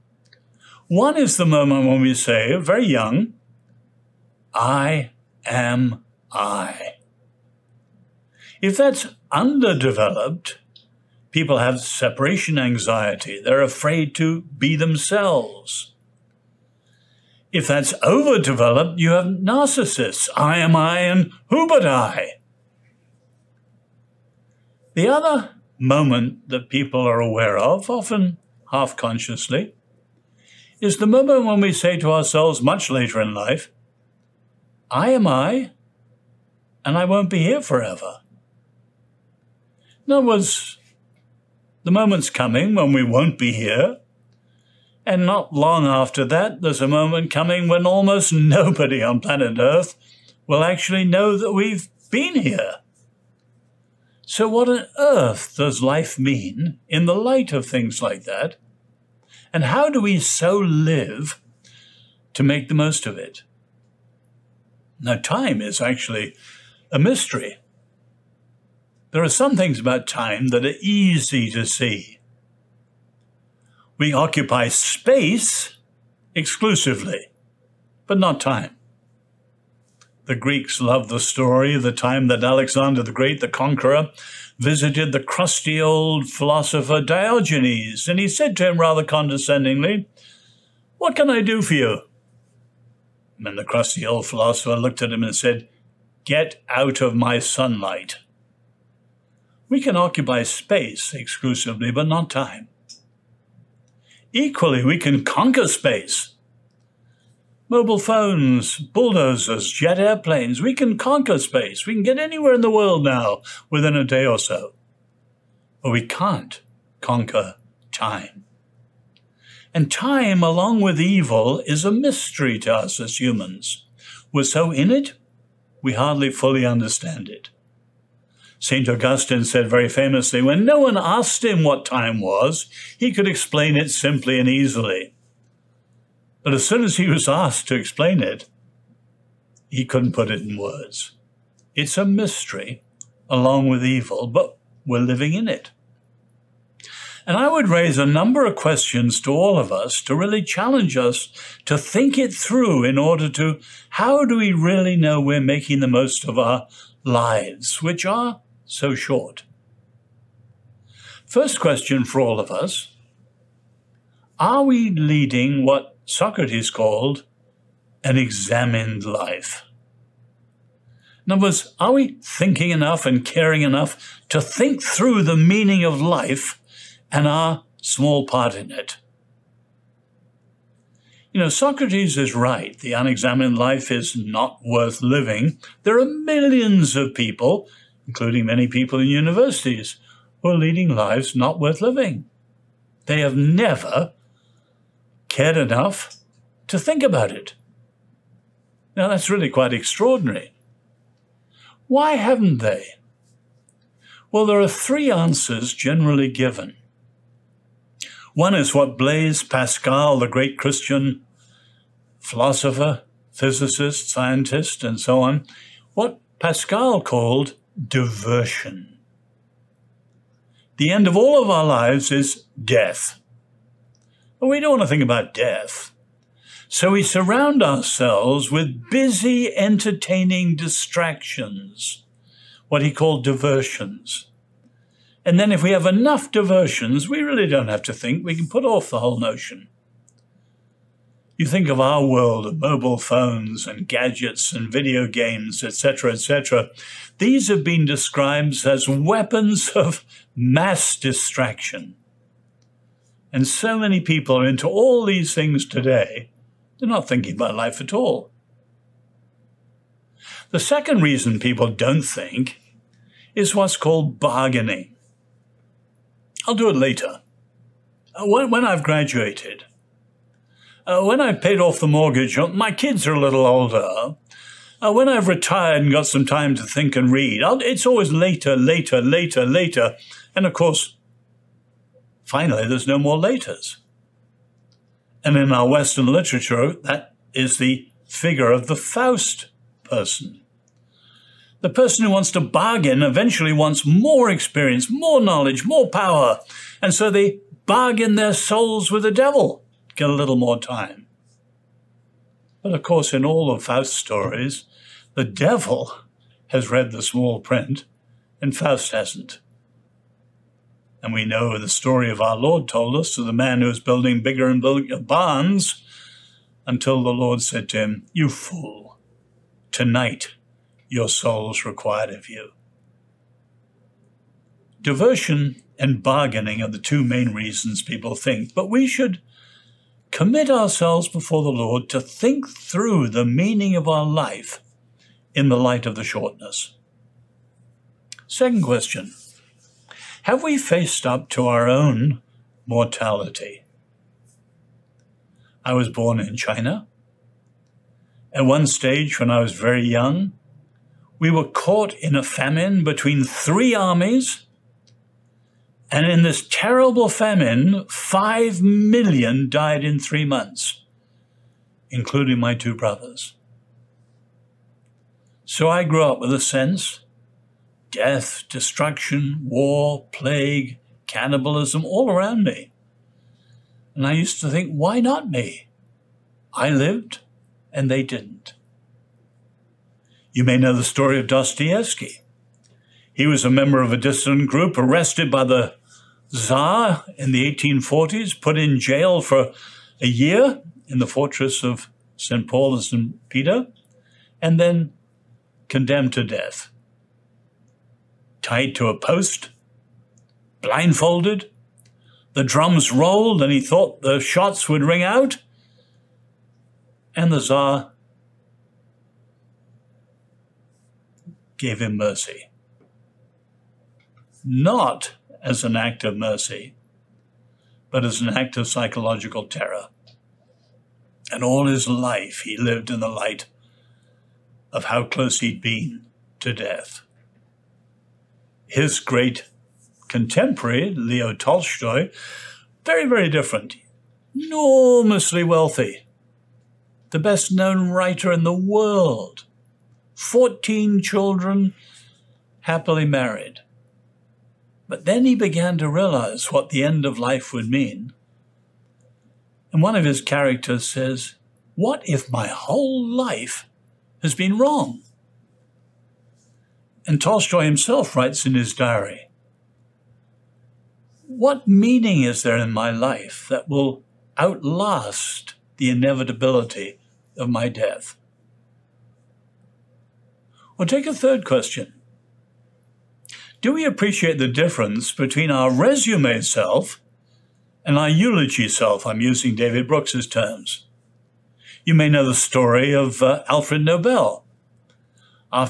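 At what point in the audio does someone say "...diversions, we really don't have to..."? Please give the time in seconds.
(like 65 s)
236 s.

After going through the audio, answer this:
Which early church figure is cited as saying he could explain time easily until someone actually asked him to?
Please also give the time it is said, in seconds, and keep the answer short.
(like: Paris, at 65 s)
St. Augustine, at 128 s.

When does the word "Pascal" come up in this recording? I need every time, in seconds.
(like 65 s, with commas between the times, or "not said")
209 s, 216 s.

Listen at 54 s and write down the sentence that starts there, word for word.
So, what on earth does life mean in the light of things like that?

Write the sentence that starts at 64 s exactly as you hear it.
Now, time is actually a mystery.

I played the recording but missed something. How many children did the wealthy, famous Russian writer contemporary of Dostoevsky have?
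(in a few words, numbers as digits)
14.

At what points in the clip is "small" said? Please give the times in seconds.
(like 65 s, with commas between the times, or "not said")
177 s, 307 s.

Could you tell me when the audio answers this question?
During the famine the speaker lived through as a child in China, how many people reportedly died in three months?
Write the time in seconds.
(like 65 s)
357 s.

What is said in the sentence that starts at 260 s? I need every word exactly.
The second reason people don't think is what's called bargaining.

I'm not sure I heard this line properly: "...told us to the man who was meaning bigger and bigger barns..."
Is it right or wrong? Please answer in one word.
wrong.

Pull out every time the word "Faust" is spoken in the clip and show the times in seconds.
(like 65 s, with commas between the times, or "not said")
288 s, 303 s, 308 s.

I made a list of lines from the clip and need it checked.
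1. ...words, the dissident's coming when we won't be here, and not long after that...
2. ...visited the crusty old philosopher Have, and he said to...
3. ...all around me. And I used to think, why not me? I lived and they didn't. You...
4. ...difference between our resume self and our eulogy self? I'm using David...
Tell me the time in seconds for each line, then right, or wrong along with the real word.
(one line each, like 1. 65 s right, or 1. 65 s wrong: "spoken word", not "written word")
1. 40 s wrong: "moment", not "dissident"
2. 84 s wrong: "Diogenes", not "Have"
3. 371 s right
4. 474 s right.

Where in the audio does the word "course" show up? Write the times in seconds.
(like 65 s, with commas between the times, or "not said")
280 s, 302 s.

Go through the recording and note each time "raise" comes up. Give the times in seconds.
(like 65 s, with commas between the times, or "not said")
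147 s.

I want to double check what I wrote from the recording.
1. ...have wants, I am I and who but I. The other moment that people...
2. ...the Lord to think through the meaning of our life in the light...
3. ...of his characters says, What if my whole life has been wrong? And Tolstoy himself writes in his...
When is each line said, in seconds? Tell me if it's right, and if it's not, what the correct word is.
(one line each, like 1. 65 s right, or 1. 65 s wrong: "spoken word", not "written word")
1. 19 s wrong: "narcissists", not "wants"
2. 331 s right
3. 449 s right.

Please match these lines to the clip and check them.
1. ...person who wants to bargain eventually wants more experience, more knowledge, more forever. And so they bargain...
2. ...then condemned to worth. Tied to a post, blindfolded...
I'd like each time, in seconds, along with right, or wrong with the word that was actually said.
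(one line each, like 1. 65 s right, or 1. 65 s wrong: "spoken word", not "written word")
1. 291 s wrong: "power", not "forever"
2. 394 s wrong: "death", not "worth".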